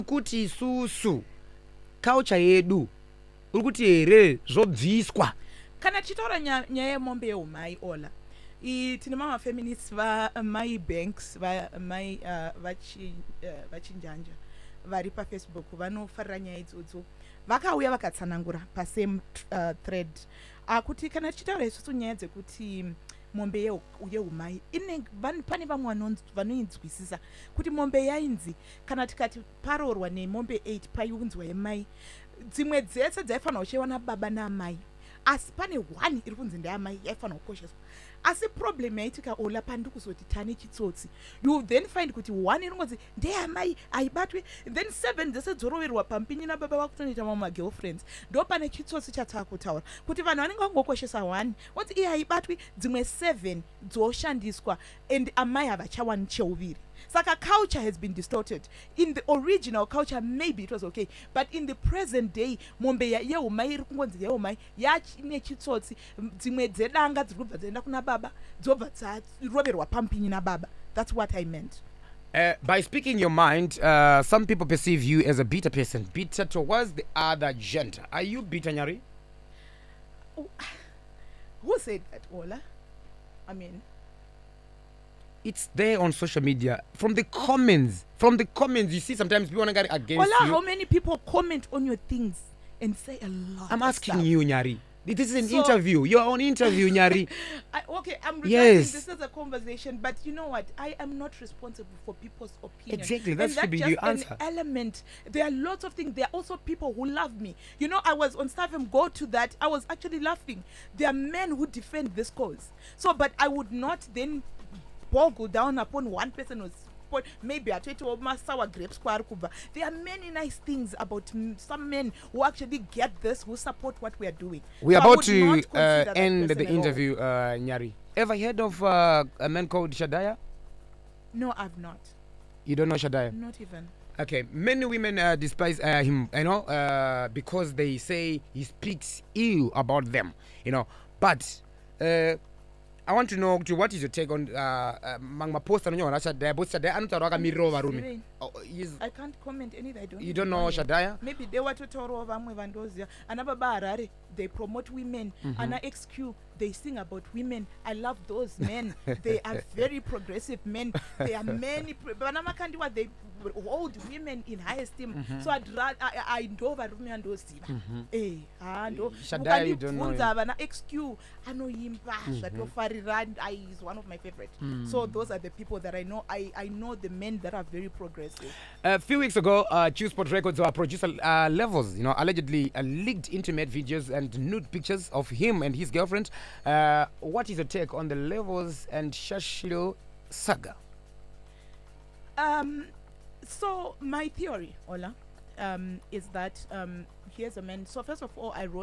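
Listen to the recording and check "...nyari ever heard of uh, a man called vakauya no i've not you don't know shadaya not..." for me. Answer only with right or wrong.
wrong.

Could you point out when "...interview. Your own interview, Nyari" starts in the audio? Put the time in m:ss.
1:35.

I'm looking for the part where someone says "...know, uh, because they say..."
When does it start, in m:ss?
2:16.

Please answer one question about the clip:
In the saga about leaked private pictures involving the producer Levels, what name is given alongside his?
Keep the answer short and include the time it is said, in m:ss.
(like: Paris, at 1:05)
Shashiro, at 3:09.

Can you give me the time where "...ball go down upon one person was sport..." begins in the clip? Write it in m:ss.
1:55.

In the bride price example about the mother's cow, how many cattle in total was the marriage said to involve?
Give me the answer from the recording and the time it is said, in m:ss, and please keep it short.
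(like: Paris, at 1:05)
8, at 0:30.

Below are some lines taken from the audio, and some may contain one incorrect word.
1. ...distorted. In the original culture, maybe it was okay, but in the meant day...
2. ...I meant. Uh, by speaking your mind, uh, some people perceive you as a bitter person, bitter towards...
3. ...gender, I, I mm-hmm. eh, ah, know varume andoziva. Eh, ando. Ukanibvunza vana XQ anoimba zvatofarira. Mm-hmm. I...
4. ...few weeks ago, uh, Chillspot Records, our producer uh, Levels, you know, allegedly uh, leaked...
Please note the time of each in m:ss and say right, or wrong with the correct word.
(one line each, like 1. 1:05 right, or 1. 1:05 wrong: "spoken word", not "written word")
1. 0:58 wrong: "present", not "meant"
2. 1:11 right
3. 2:45 wrong: "rather", not "gender"
4. 2:58 right.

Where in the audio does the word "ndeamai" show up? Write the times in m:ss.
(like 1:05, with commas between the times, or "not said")
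0:36, 0:43.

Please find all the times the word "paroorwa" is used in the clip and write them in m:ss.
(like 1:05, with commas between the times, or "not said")
0:29.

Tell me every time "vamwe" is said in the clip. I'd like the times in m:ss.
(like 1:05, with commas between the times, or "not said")
0:25, 2:32.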